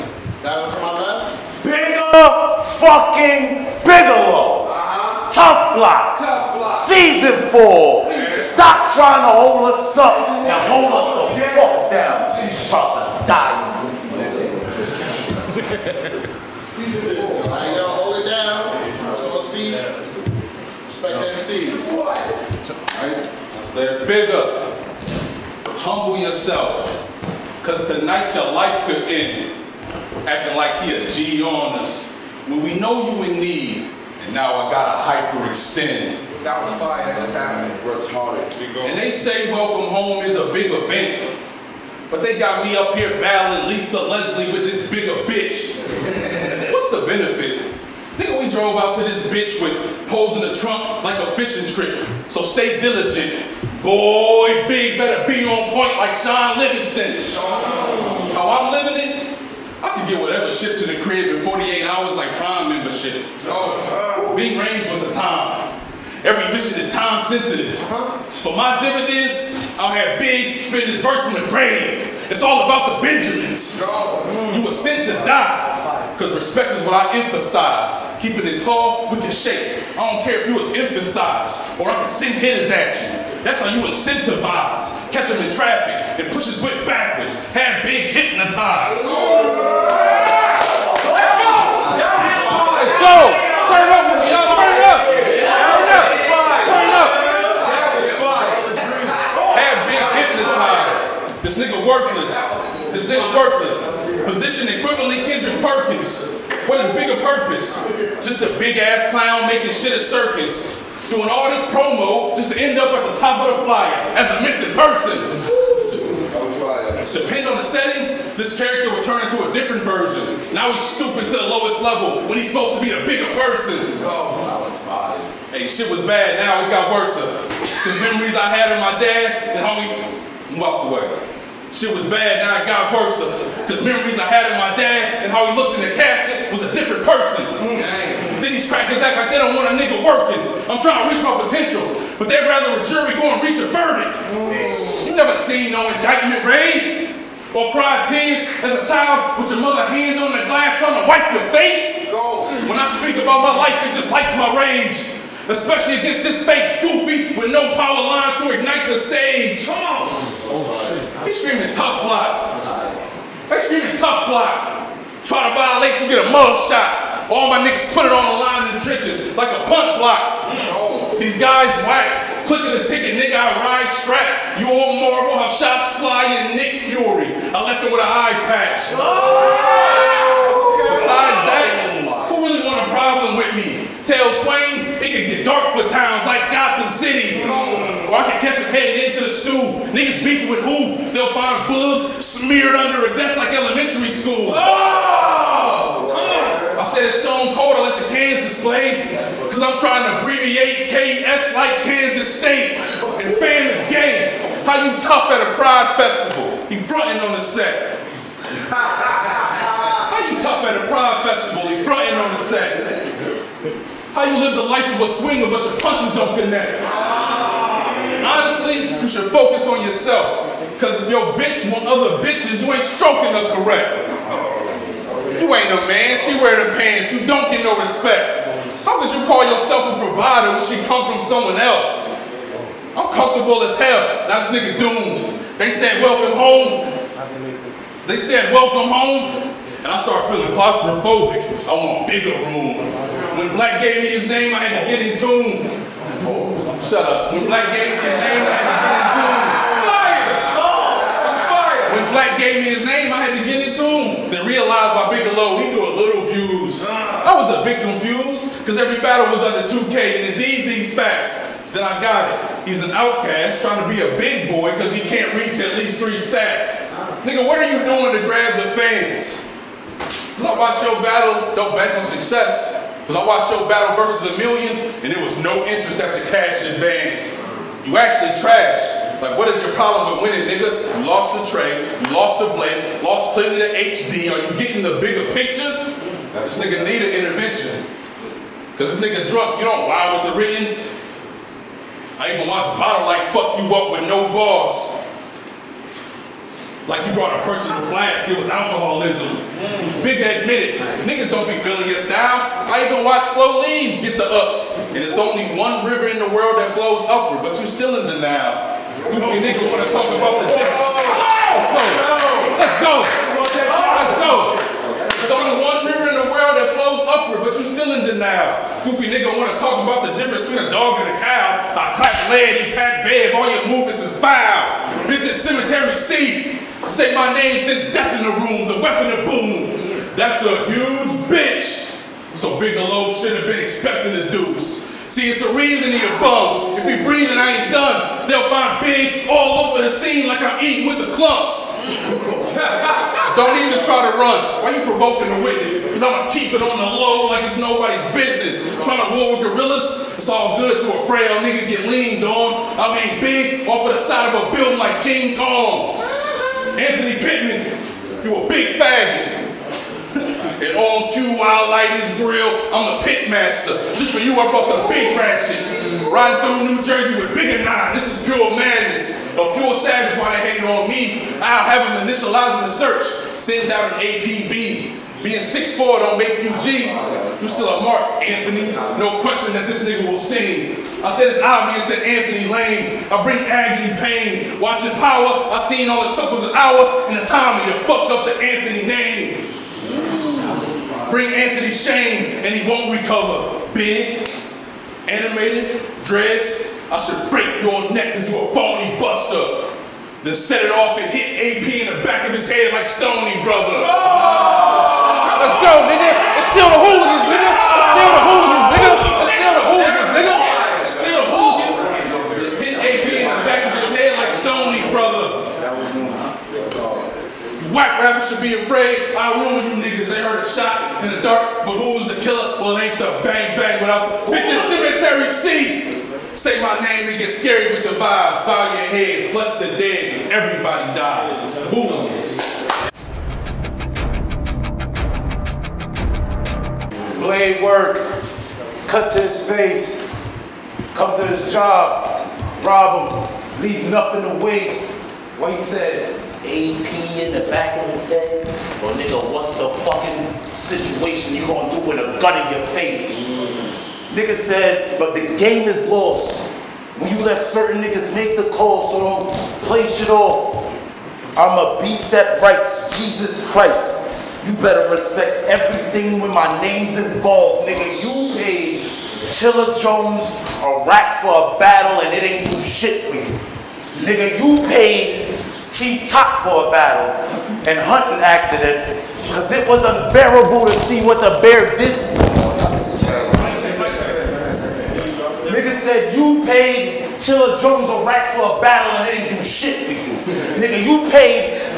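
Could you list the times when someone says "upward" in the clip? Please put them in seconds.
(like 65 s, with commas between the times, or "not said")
307 s, 317 s.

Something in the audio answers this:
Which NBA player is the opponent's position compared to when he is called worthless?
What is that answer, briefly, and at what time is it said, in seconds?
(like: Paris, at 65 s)
Kendrick Perkins, at 105 s.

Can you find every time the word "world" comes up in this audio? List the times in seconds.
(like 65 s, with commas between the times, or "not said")
306 s, 316 s.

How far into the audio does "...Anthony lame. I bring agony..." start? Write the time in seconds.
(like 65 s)
382 s.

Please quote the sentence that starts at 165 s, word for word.
Try to violate, you get a mug shot.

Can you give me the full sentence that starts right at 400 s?
Then set it off and hit AP in the back of his head like Stony Brother.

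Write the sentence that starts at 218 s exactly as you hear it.
Honestly, you should focus on yourself.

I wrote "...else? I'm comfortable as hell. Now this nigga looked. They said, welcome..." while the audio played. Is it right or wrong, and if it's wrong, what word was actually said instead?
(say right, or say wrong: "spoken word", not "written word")
wrong: "doomed", not "looked".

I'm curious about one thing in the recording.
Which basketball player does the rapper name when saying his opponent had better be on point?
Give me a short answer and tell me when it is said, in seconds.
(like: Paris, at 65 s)
Shaun Livingston, at 56 s.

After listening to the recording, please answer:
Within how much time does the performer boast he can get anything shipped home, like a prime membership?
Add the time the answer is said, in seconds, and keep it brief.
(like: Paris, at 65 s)
48 hours, at 61 s.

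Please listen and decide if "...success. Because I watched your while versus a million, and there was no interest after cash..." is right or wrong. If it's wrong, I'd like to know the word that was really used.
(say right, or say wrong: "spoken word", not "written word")
wrong: "battle", not "while".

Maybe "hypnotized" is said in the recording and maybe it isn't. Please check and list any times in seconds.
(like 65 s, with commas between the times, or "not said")
88 s, 100 s.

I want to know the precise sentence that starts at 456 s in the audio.
When you let certain niggas make the call, so don't play shit off.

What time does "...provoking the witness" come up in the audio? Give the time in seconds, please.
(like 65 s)
344 s.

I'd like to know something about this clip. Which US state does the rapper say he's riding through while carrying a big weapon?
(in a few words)
New Jersey.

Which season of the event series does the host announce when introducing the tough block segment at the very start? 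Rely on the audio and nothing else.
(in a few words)
Season 4.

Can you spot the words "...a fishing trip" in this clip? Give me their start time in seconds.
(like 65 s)
51 s.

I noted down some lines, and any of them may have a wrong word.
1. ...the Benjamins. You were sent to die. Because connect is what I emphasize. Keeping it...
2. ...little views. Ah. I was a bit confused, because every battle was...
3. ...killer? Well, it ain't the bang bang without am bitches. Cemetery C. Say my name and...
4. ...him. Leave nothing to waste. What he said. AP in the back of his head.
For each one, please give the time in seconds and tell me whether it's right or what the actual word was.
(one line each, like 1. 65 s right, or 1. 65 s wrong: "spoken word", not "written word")
1. 73 s wrong: "respect", not "connect"
2. 255 s right
3. 422 s right
4. 443 s right.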